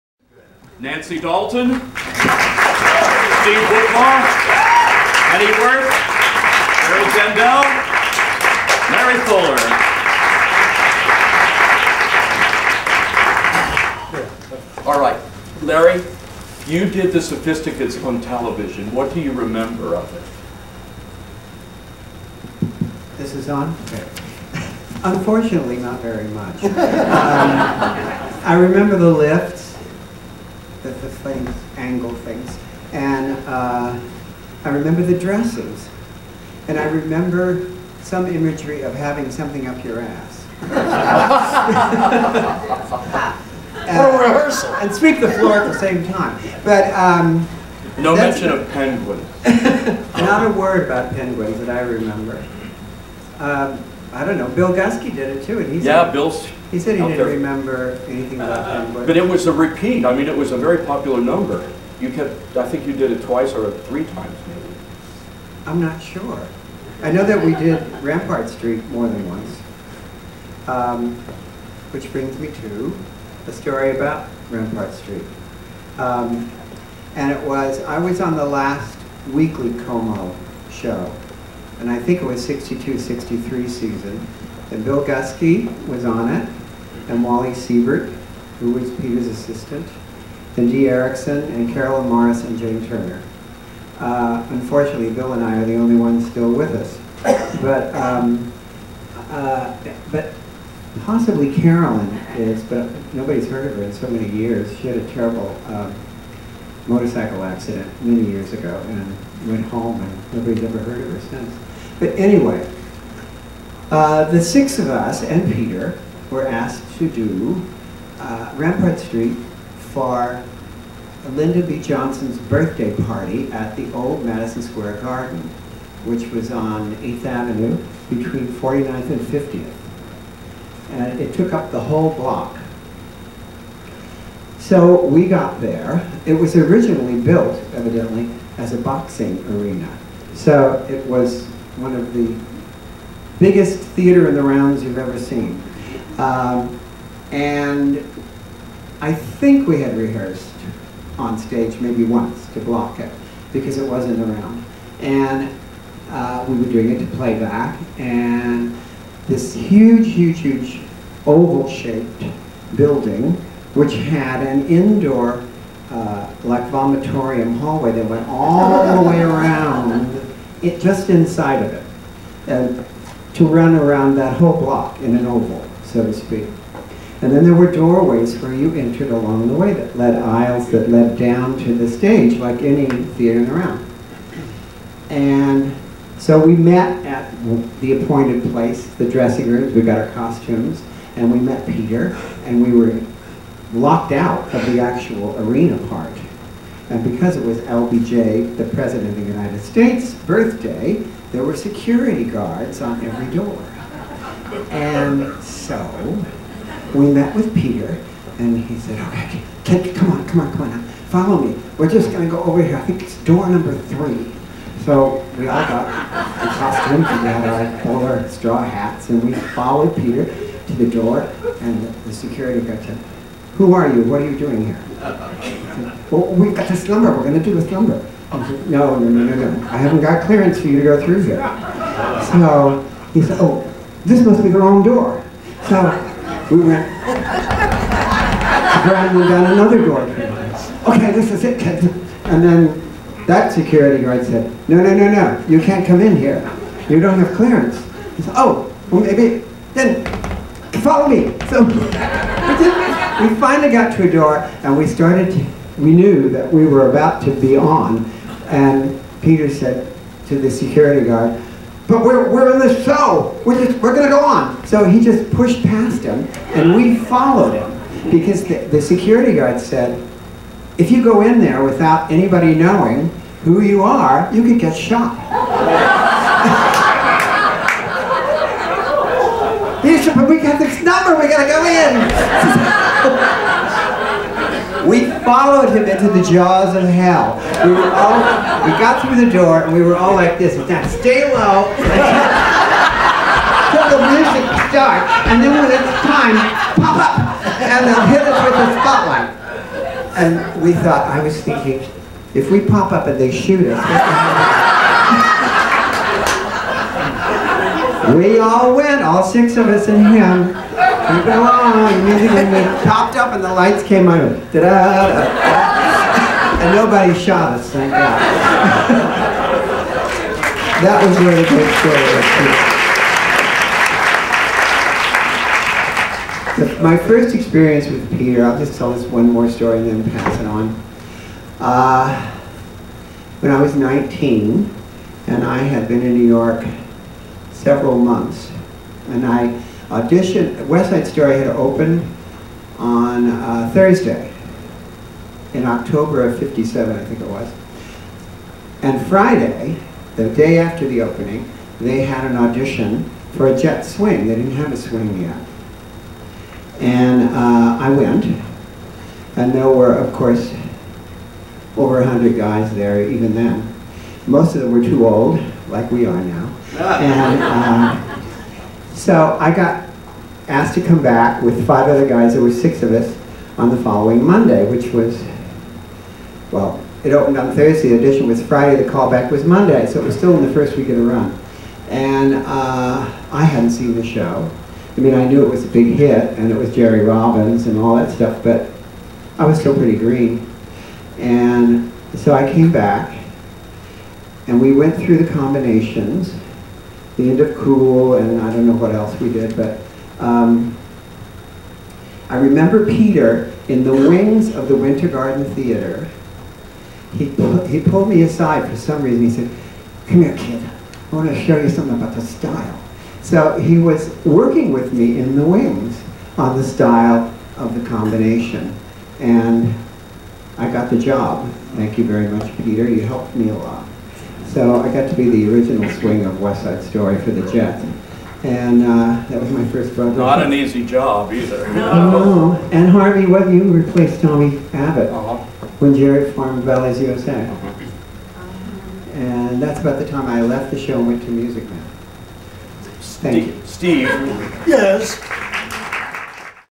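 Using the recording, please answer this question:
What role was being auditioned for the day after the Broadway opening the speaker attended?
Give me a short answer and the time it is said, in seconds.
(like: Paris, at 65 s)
Jet swing, at 353 s.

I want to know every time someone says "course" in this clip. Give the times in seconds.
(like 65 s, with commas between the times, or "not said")
360 s.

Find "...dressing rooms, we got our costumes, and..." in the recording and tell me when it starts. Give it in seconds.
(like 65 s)
189 s.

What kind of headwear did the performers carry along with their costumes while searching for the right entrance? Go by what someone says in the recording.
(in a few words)
Straw hats.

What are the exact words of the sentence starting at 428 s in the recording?
And uh, that was my first project.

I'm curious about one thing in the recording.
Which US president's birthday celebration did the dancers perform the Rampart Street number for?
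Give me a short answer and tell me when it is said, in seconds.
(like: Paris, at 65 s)
Lyndon B. Johnson, at 121 s.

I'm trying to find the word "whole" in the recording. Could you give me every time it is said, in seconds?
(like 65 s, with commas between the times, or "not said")
131 s, 174 s.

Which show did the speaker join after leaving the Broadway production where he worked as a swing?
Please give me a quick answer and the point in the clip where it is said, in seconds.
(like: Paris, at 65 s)
Music Man, at 441 s.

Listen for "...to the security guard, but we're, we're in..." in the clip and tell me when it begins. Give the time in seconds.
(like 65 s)
260 s.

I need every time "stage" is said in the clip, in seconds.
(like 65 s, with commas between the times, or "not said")
151 s, 181 s.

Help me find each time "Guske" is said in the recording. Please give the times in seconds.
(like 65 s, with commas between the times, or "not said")
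54 s, 85 s.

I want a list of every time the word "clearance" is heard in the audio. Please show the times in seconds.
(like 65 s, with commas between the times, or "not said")
230 s, 247 s.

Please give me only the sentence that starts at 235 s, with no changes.
So we went to and down another door.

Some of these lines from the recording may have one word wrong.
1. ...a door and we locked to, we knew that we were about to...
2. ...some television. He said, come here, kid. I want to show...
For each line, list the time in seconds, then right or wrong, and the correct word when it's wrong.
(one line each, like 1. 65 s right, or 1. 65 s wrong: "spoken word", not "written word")
1. 254 s wrong: "started", not "locked"
2. 408 s wrong: "reason", not "television".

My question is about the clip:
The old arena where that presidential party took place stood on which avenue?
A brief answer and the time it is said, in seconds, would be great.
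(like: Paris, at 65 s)
8th Avenue, at 126 s.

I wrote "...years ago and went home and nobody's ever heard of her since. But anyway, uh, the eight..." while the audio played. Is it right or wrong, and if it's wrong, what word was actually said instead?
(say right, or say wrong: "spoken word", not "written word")
wrong: "six", not "eight".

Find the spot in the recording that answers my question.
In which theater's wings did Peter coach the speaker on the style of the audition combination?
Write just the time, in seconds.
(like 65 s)
404 s.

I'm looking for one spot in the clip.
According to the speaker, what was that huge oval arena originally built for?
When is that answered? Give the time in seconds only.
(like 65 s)
138 s.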